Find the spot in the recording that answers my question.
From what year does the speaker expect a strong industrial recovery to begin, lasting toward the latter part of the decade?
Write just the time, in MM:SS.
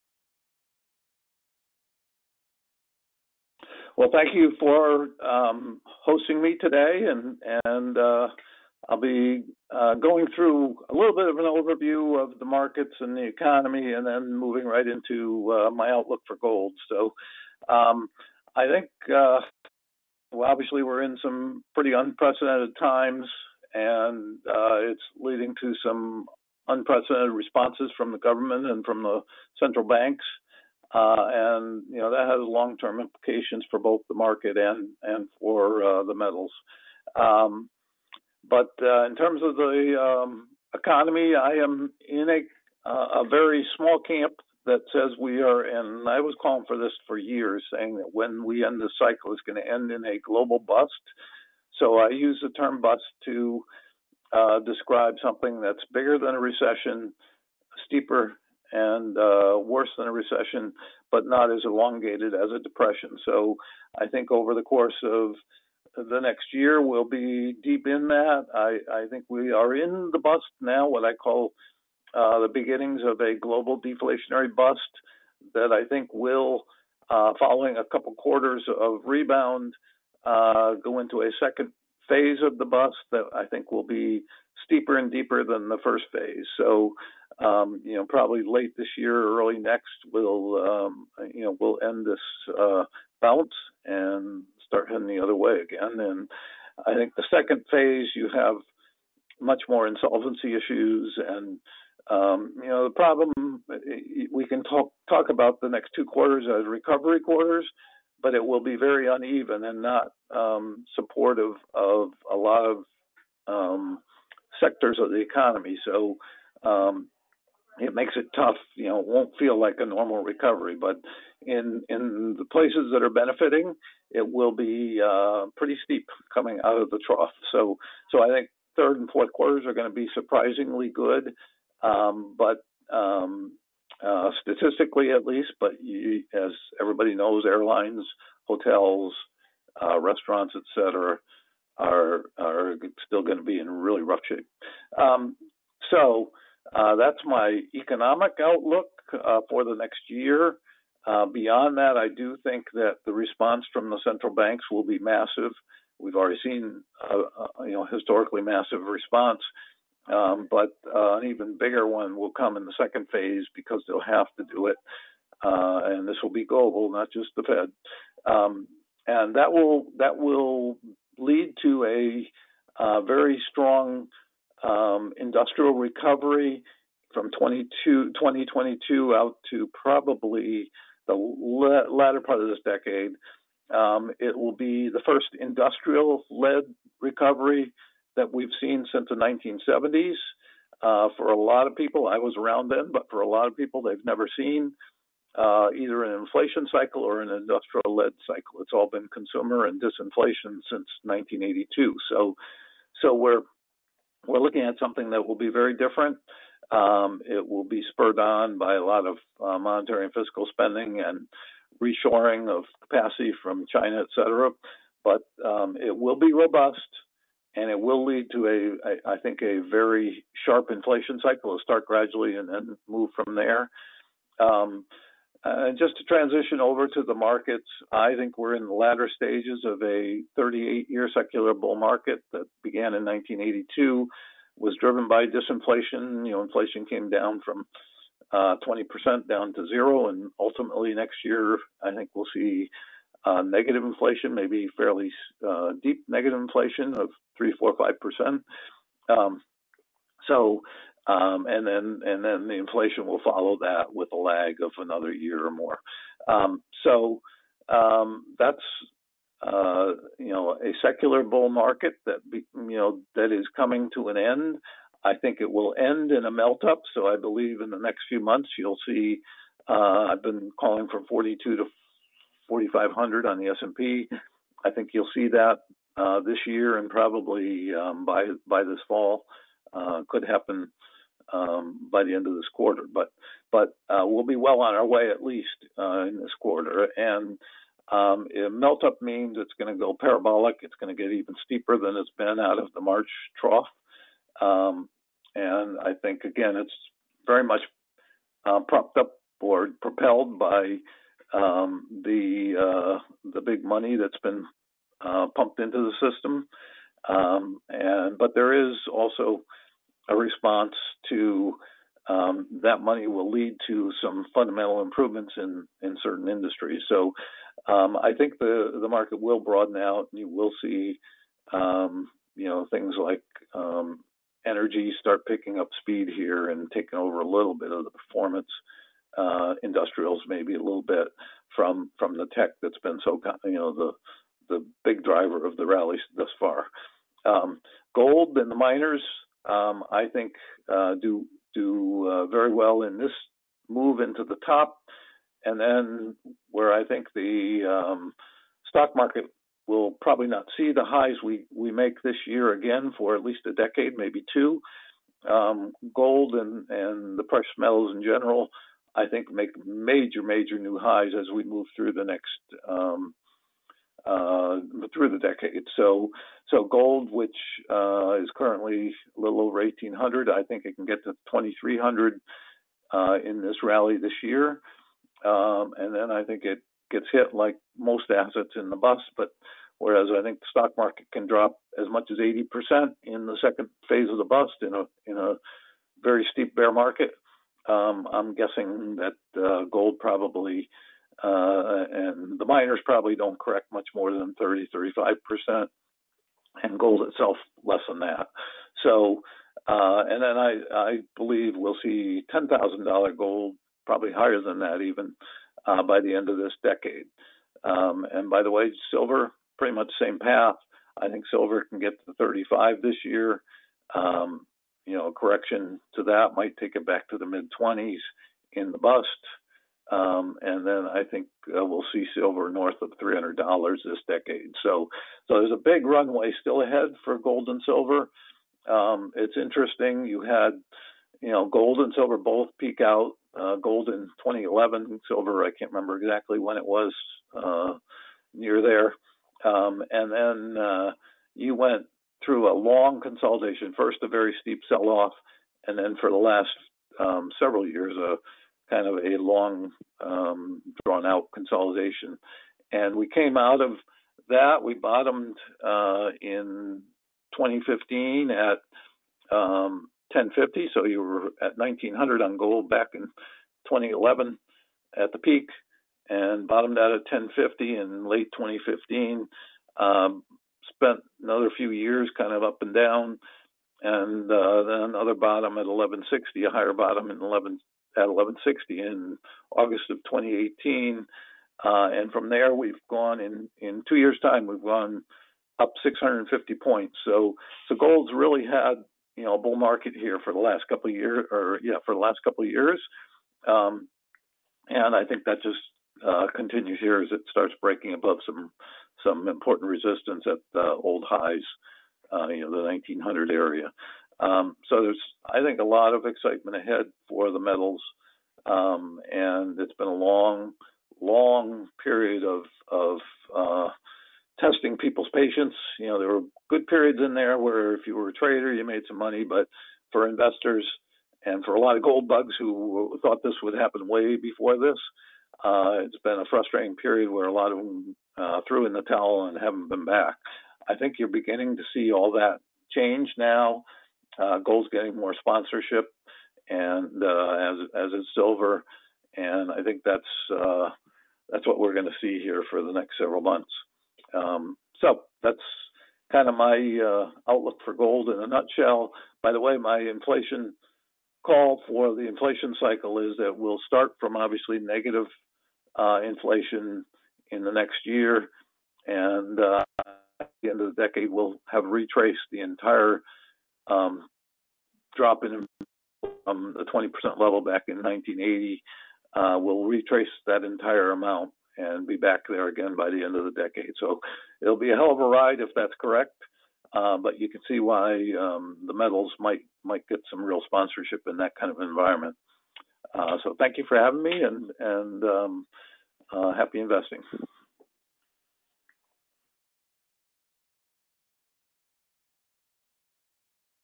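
02:57.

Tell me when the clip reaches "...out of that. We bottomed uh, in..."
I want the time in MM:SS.
07:33.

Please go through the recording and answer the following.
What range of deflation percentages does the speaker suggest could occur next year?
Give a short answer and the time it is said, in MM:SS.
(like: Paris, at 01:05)
3 to 5 percent, at 04:07.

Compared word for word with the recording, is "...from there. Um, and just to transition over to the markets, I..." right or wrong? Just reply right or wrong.
right.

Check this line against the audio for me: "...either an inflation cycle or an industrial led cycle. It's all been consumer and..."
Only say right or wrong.
right.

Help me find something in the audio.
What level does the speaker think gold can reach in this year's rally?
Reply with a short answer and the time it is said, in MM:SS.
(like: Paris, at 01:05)
2,300, at 06:11.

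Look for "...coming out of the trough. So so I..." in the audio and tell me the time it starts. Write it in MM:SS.
02:06.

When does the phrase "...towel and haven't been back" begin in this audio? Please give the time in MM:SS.
08:48.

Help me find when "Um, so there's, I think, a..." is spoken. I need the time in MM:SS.
08:24.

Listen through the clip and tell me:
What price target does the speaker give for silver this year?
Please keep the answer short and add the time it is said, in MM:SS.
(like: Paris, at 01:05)
35, at 06:51.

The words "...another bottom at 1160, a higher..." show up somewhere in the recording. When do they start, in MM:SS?
07:54.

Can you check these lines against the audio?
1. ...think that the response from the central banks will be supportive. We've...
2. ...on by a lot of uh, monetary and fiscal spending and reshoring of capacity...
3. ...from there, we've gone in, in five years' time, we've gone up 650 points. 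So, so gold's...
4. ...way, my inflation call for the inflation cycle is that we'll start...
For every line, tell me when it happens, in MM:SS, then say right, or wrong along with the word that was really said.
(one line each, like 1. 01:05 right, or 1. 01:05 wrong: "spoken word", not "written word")
1. 02:32 wrong: "massive", not "supportive"
2. 03:28 right
3. 08:02 wrong: "two", not "five"
4. 09:09 right.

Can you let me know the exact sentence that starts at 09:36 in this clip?
Uh, but you can see why um, the metals might might get some real sponsorship in that kind of environment.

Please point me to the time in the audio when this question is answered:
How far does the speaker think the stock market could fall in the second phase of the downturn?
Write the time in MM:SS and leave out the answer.
06:22.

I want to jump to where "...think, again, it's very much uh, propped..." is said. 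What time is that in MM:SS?
04:56.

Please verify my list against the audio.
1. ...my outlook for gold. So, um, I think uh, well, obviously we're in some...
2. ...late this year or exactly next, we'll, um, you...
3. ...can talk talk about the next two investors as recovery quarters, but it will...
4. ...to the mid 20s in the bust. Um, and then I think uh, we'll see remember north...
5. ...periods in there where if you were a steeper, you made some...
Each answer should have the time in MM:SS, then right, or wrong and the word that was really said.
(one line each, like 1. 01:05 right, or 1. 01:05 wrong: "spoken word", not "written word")
1. 00:15 right
2. 01:28 wrong: "early", not "exactly"
3. 01:44 wrong: "quarters", not "investors"
4. 06:57 wrong: "silver", not "remember"
5. 08:36 wrong: "trader", not "steeper".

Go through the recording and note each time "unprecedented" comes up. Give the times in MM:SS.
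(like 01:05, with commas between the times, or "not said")
00:21, 00:26.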